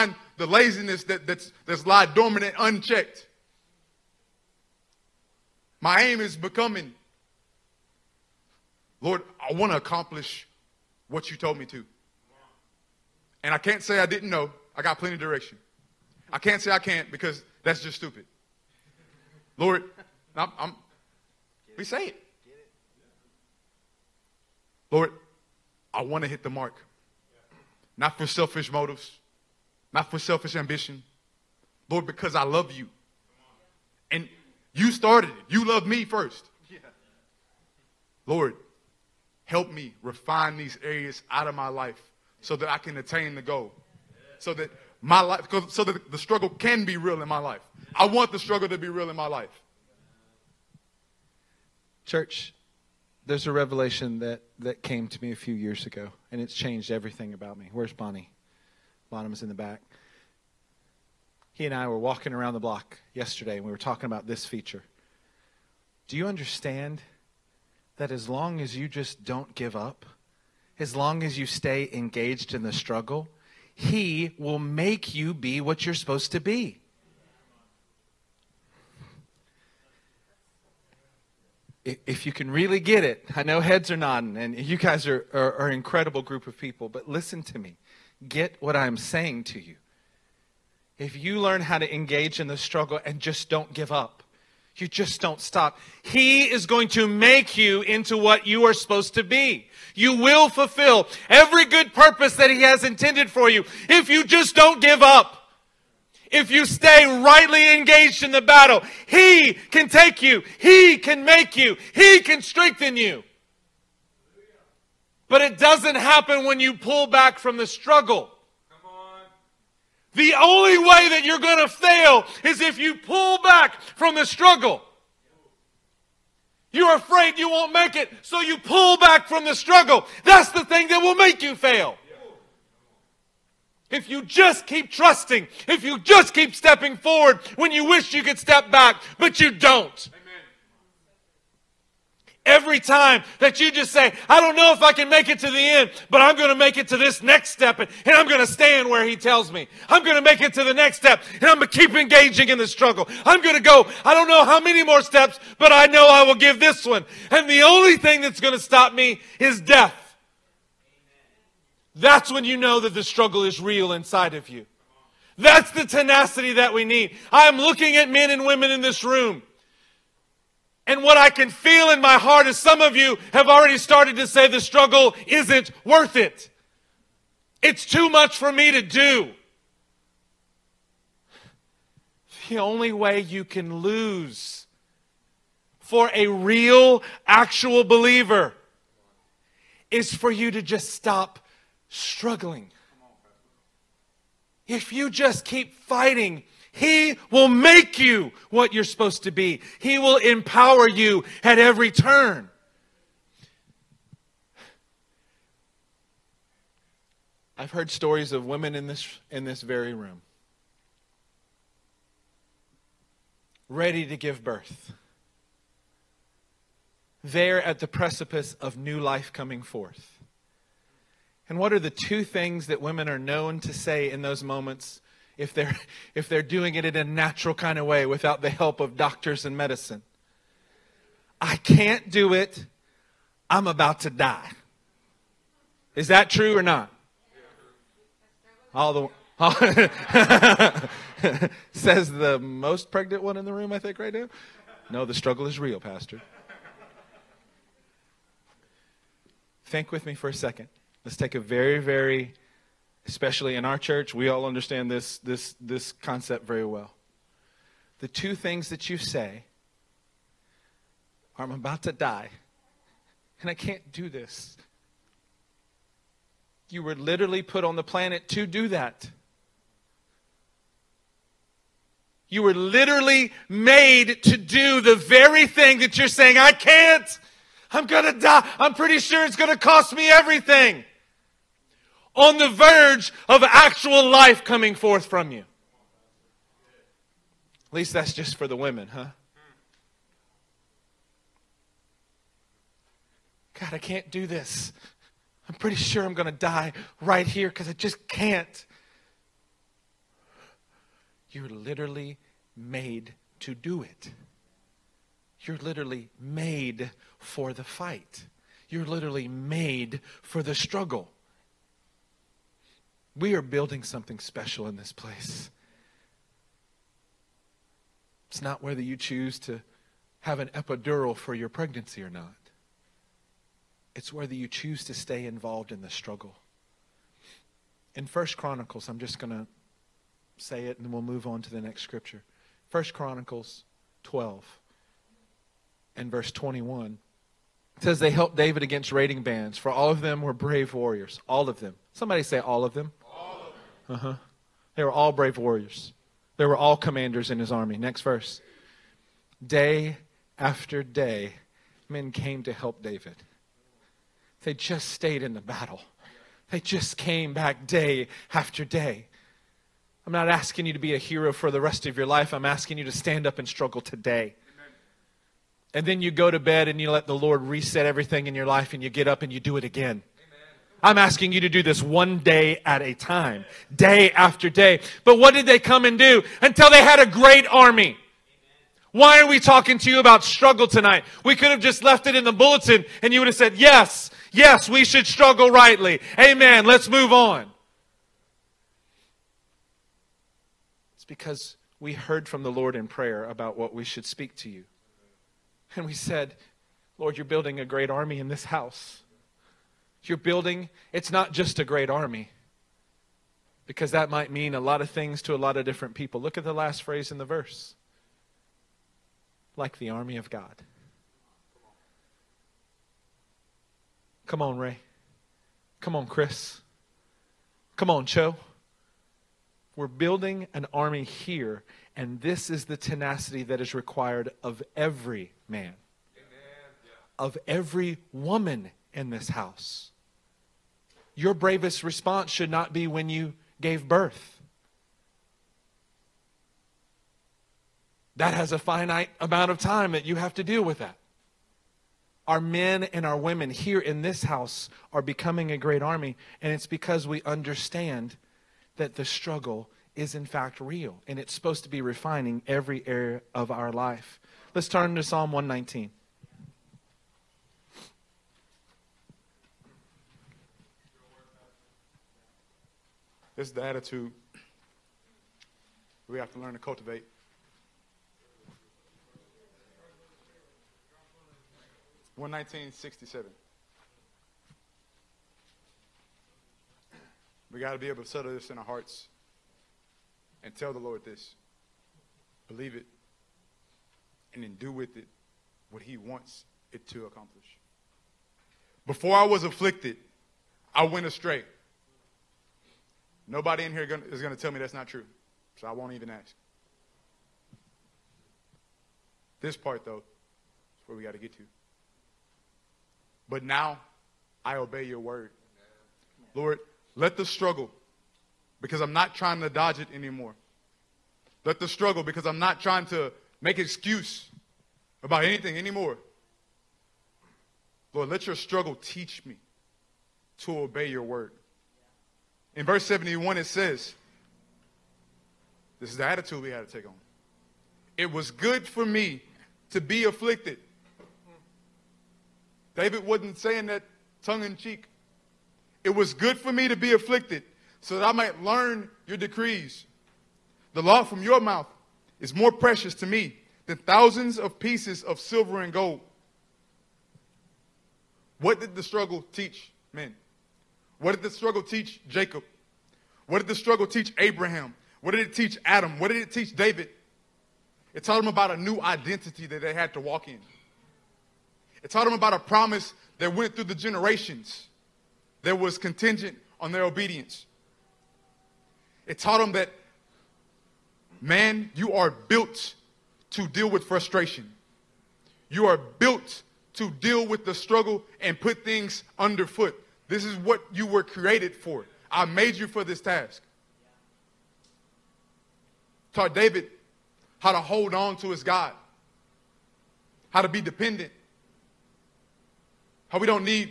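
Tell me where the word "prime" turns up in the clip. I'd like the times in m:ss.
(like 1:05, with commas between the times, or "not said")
not said.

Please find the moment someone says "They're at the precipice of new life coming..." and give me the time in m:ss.
3:37.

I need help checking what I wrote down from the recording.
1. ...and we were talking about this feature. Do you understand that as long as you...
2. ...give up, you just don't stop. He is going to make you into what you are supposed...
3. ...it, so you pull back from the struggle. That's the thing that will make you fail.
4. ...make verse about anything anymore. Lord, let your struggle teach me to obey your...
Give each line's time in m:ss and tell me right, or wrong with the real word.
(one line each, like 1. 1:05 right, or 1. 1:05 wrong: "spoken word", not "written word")
1. 1:03 right
2. 1:33 right
3. 2:07 right
4. 8:33 wrong: "excuse", not "verse".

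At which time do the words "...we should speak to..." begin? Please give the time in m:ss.
6:33.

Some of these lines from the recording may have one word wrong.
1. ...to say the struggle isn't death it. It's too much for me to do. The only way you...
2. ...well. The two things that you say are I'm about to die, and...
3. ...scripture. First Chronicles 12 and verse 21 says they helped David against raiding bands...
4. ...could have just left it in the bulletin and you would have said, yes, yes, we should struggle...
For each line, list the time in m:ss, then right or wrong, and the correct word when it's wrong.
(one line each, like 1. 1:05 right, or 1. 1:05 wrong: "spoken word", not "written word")
1. 2:54 wrong: "worth", not "death"
2. 4:16 right
3. 5:31 right
4. 6:21 right.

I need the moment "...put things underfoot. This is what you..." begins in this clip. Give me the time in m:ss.
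9:38.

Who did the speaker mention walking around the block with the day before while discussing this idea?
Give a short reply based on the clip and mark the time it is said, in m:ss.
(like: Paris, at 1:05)
Bonham, at 0:59.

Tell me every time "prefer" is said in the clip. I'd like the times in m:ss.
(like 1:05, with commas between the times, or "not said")
not said.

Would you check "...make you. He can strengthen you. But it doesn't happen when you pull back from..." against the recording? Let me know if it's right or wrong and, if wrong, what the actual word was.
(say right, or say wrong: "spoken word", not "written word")
right.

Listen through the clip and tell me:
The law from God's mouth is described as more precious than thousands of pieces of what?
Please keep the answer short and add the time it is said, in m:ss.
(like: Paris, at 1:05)
Silver and gold, at 9:05.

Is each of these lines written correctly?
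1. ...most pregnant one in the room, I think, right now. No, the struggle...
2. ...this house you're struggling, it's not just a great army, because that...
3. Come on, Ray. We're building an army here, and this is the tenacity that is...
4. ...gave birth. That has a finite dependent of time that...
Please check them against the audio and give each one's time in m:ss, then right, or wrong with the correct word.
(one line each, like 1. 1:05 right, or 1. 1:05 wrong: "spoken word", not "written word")
1. 4:02 right
2. 6:38 wrong: "building", not "struggling"
3. 6:57 wrong: "Cho", not "Ray"
4. 7:13 wrong: "amount", not "dependent".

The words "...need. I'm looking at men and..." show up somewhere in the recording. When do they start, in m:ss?
2:46.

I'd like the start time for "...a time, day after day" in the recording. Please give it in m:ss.
6:12.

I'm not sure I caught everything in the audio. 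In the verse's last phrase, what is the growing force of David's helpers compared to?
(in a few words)
The army of God.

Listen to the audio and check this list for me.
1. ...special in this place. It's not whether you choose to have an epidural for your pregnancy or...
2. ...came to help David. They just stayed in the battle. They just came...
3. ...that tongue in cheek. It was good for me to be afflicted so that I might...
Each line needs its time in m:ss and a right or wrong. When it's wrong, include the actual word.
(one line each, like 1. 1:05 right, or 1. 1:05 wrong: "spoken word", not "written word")
1. 5:14 right
2. 5:52 right
3. 8:53 right.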